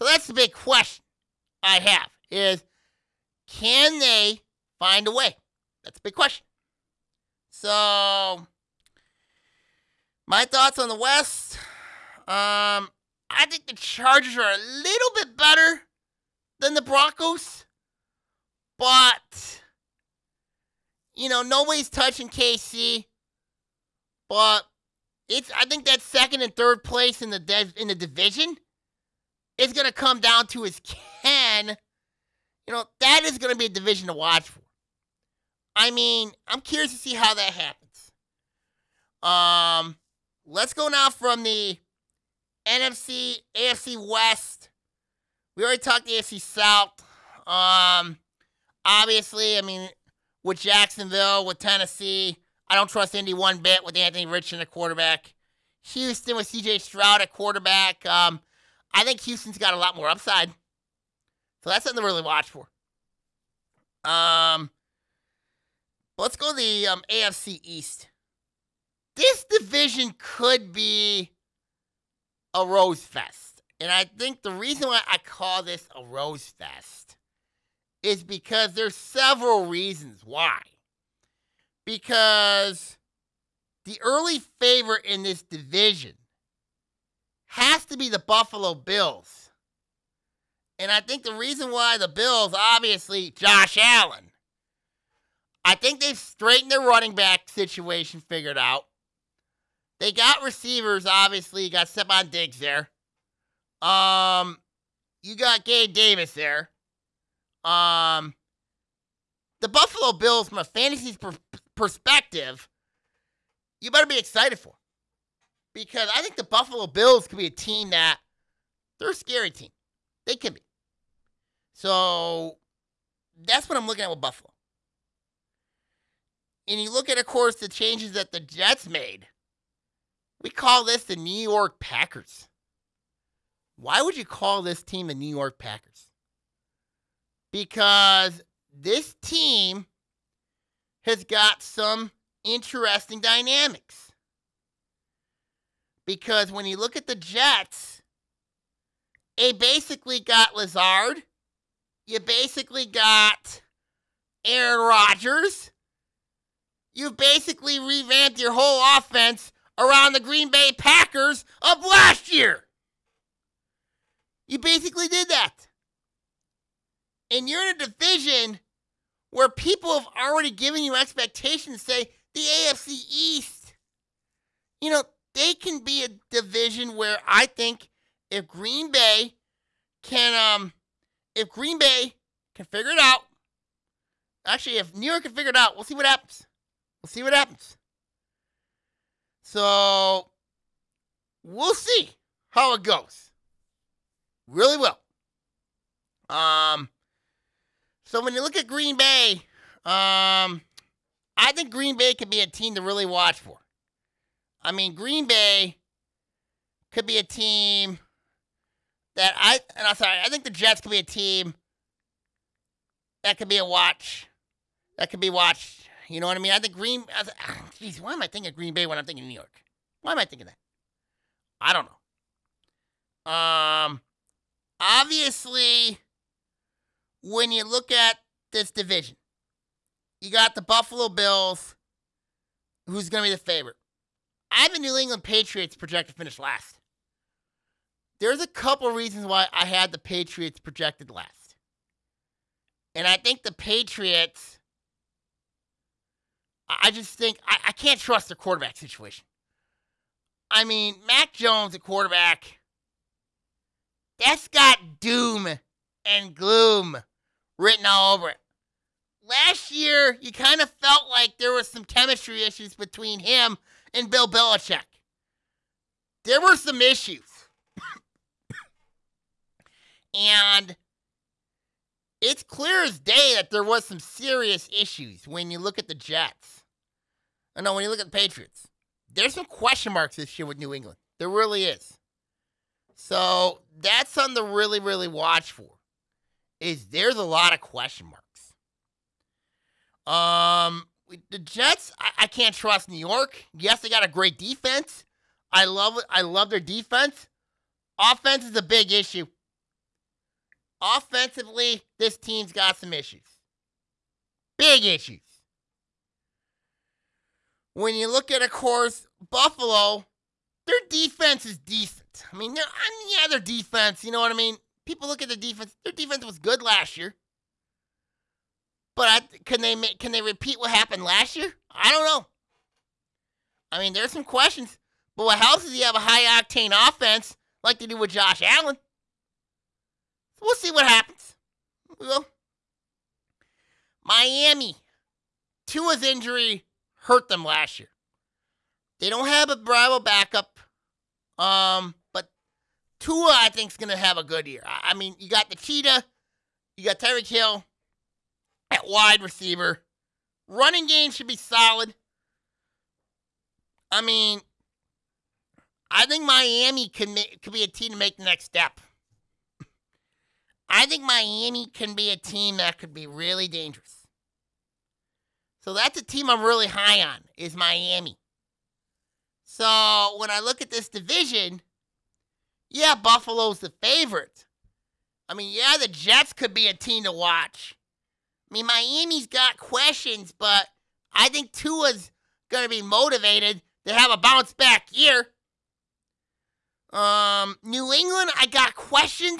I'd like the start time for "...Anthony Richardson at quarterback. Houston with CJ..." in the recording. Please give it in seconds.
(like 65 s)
53 s.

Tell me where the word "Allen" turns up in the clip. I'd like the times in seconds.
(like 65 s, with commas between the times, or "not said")
93 s, 328 s.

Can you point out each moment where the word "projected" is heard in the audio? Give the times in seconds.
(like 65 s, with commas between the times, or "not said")
235 s, 240 s.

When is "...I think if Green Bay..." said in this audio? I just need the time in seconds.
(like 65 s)
177 s.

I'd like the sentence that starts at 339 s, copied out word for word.
They don't have a Bravo backup, um, but Tua I think is going to have a good year.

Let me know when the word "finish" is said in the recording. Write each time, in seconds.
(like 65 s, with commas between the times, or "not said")
236 s.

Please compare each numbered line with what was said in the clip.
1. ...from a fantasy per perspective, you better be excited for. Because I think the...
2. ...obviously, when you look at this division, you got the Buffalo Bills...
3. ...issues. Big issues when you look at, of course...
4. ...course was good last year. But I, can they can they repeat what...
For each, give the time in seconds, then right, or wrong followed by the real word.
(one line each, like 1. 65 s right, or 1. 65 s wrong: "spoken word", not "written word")
1. 110 s right
2. 224 s right
3. 302 s right
4. 315 s wrong: "defense", not "course".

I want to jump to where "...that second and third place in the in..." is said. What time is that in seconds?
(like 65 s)
25 s.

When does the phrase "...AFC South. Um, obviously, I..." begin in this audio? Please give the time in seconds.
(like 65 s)
46 s.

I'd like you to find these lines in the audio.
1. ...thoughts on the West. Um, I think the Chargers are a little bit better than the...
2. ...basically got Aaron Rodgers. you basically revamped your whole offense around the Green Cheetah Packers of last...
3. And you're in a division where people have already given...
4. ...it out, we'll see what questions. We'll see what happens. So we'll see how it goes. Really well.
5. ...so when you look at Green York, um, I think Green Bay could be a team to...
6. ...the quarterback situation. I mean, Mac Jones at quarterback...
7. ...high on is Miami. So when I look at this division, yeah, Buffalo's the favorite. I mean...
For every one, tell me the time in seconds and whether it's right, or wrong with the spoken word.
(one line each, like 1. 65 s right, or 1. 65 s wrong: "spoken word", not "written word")
1. 10 s right
2. 152 s wrong: "Bay", not "Cheetah"
3. 167 s right
4. 185 s wrong: "happens", not "questions"
5. 198 s wrong: "Bay", not "York"
6. 248 s right
7. 366 s right.